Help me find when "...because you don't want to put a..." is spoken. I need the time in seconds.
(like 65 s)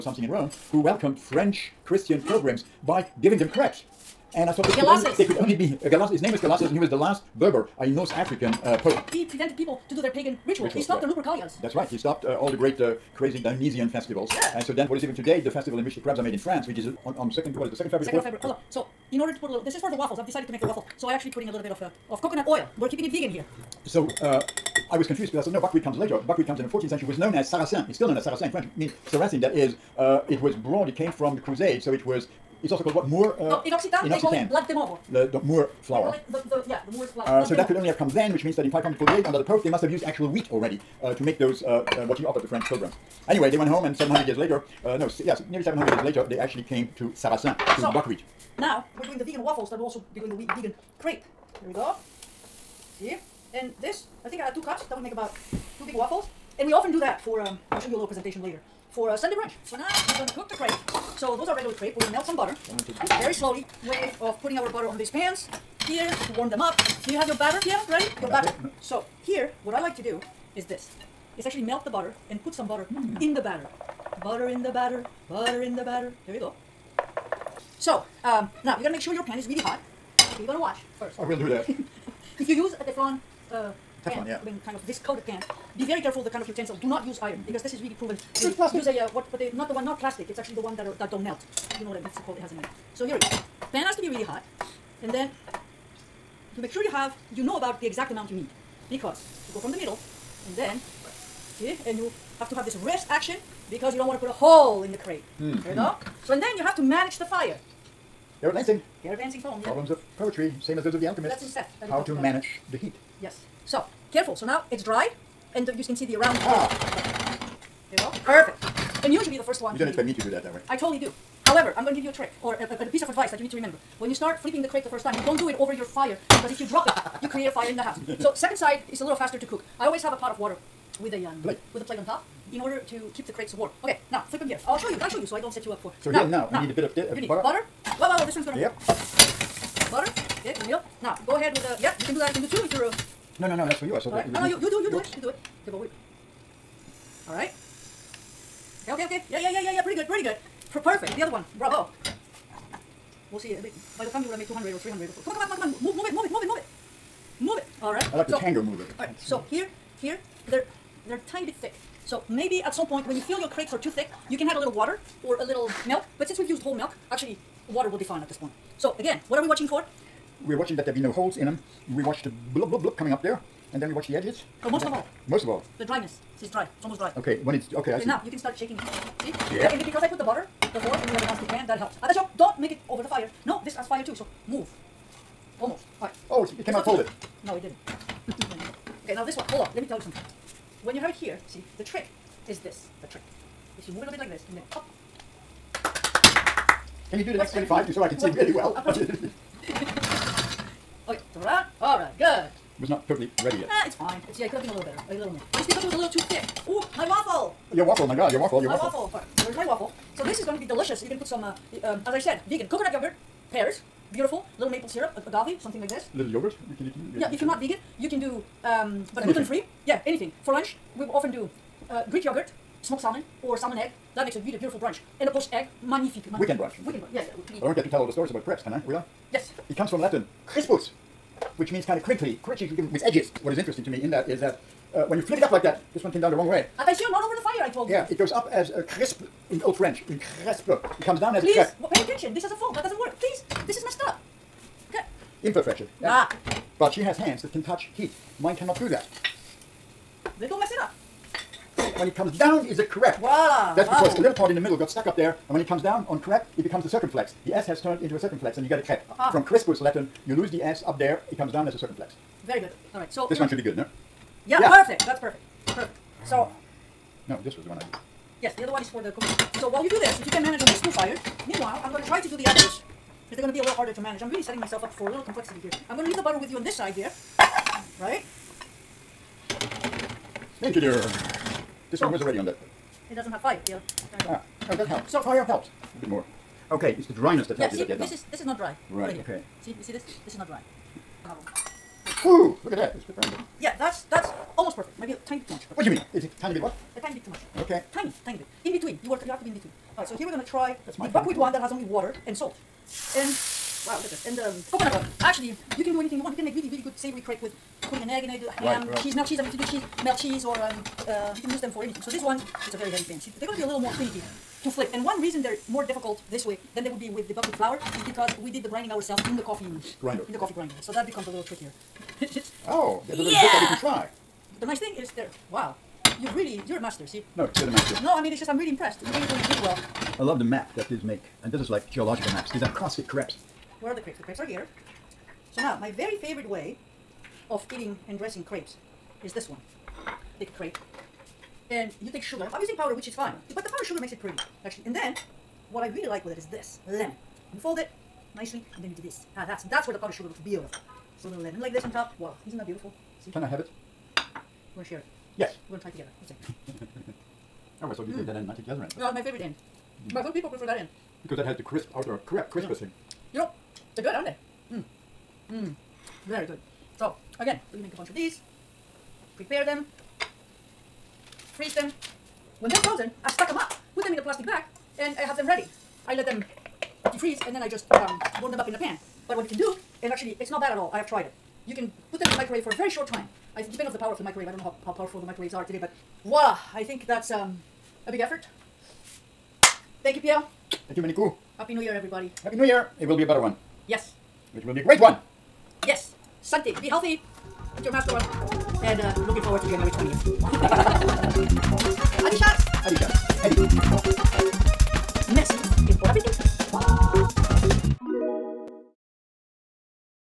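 103 s.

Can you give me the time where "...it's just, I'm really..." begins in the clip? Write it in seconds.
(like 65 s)
328 s.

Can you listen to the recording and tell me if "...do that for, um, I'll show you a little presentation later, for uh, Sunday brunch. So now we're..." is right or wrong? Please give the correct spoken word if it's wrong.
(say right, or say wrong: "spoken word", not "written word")
right.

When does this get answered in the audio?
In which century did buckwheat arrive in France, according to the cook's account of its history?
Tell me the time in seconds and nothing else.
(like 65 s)
26 s.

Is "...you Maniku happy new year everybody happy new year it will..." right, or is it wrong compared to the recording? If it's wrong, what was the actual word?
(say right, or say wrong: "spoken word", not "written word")
right.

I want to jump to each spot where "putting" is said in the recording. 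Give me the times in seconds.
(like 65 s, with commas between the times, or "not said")
21 s, 64 s, 307 s.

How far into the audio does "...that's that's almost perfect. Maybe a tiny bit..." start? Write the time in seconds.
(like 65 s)
293 s.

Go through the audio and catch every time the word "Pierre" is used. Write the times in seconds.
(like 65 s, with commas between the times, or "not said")
67 s, 390 s.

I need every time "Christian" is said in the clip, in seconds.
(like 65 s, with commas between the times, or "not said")
1 s.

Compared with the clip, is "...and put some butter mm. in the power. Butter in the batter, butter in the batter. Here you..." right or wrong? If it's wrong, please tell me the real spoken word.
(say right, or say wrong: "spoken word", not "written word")
wrong: "batter", not "power".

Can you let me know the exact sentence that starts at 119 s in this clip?
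You don't expect me to do that that way.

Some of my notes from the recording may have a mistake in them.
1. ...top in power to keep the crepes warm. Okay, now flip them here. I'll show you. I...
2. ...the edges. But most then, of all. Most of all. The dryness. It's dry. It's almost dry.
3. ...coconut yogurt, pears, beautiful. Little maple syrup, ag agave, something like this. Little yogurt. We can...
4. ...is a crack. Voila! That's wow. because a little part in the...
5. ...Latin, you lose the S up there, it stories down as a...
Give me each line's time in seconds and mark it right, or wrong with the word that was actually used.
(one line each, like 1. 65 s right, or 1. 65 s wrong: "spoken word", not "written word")
1. 132 s wrong: "order", not "power"
2. 174 s right
3. 212 s right
4. 252 s right
5. 259 s wrong: "comes", not "stories".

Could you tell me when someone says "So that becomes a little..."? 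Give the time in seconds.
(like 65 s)
320 s.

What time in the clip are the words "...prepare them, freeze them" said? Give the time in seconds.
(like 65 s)
369 s.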